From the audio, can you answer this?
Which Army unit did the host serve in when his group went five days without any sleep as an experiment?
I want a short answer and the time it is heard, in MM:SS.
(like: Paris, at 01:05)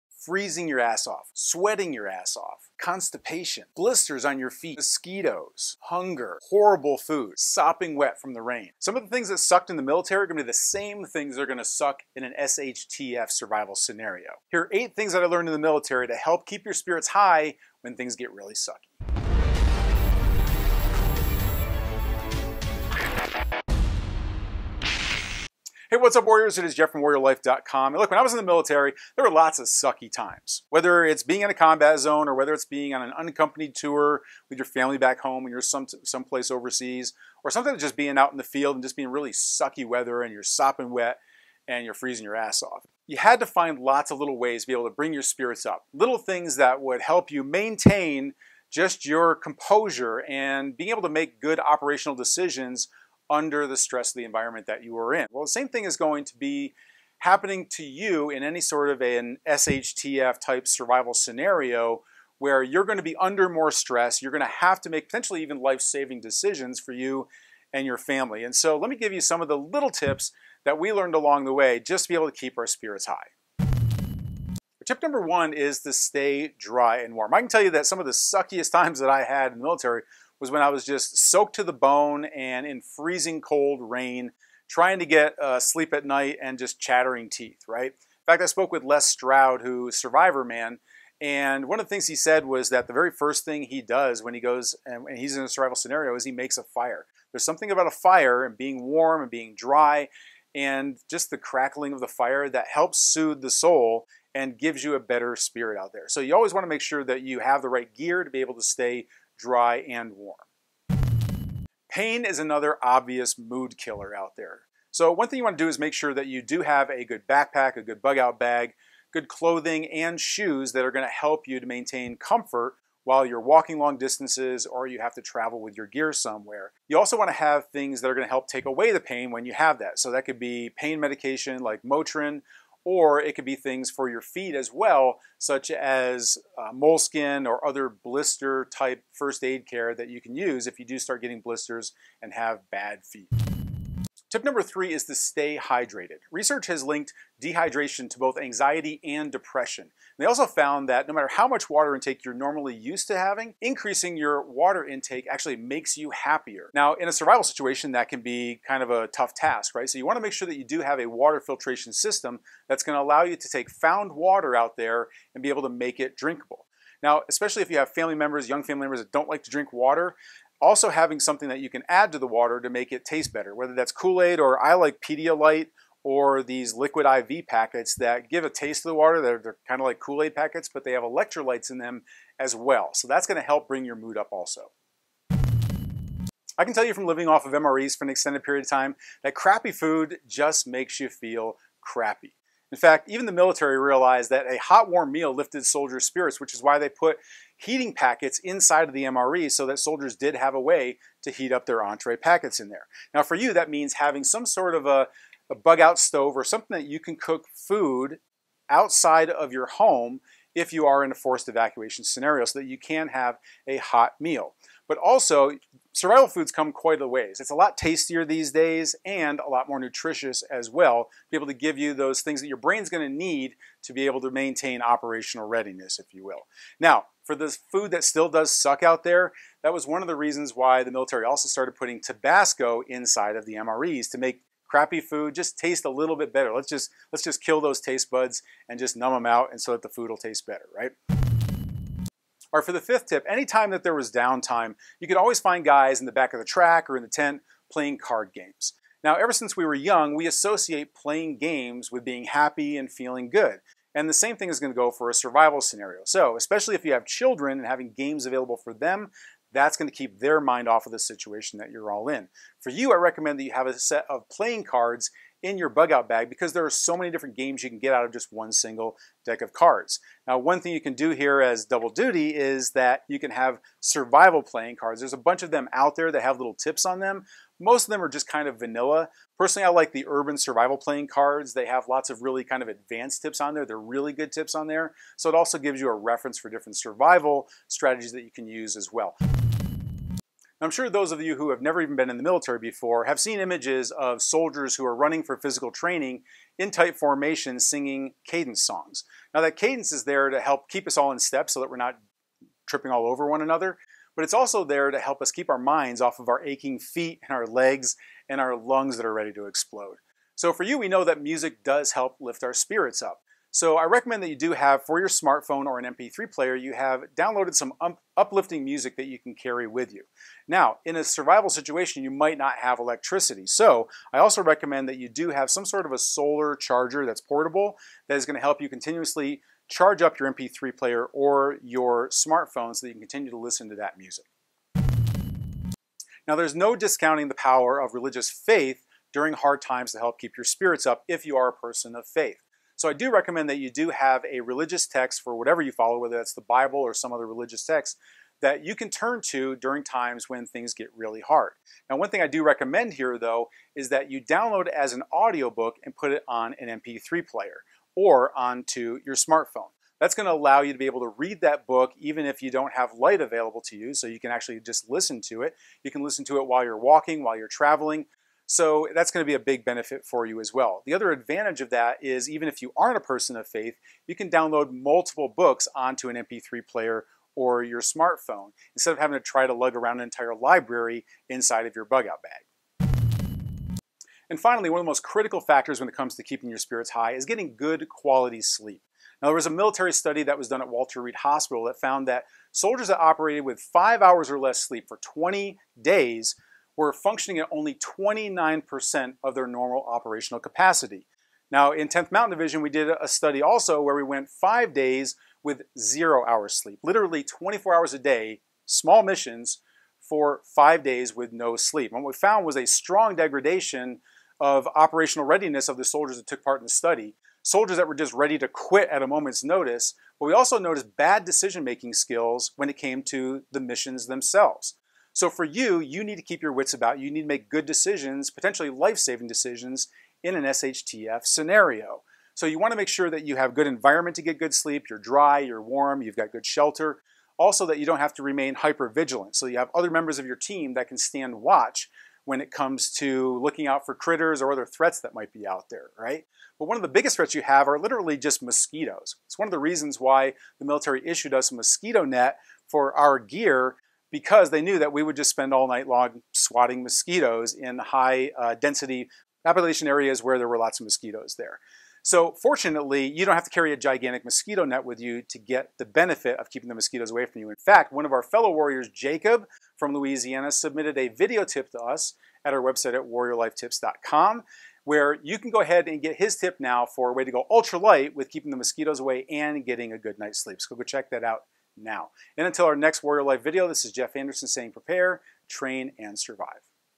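10th Mountain Division, at 06:41.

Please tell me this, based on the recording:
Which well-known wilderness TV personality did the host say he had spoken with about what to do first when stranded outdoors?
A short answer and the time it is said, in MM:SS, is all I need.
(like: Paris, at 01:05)
Les Stroud, at 01:28.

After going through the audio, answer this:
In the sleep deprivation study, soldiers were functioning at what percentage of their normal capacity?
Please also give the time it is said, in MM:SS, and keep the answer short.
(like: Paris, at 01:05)
29%, at 06:37.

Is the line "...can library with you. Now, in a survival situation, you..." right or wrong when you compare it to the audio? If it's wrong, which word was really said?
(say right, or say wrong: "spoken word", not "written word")
wrong: "carry", not "library".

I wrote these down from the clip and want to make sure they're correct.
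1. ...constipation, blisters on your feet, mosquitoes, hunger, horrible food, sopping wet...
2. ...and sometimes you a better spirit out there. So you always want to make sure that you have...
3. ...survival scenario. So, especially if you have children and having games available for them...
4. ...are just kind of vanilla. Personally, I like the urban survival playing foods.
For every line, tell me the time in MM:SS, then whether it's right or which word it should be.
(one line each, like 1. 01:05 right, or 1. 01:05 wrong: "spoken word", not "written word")
1. 00:02 right
2. 01:44 wrong: "gives", not "sometimes"
3. 04:15 right
4. 04:38 wrong: "cards", not "foods".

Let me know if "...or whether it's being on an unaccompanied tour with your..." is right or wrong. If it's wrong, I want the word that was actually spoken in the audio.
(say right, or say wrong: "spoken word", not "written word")
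right.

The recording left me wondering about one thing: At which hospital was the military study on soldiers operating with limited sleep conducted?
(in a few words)
Walter Reed Hospital.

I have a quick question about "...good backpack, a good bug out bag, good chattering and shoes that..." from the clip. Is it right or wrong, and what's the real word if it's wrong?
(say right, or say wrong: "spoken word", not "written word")
wrong: "clothing", not "chattering".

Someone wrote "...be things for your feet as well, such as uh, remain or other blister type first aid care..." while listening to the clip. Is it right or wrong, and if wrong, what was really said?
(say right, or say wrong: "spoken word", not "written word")
wrong: "moleskin", not "remain".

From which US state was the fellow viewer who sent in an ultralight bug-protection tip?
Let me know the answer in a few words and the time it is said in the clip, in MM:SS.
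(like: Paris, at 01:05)
Louisiana, at 07:49.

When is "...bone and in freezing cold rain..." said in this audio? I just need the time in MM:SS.
01:21.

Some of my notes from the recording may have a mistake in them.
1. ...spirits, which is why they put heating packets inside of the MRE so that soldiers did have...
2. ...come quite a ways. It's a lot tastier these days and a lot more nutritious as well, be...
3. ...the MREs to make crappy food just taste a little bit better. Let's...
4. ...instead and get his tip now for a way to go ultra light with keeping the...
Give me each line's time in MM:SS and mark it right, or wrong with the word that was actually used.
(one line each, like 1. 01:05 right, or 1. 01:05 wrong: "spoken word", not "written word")
1. 03:16 right
2. 03:36 right
3. 03:53 right
4. 07:55 wrong: "ahead", not "instead".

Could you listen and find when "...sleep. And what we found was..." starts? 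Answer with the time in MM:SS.
06:51.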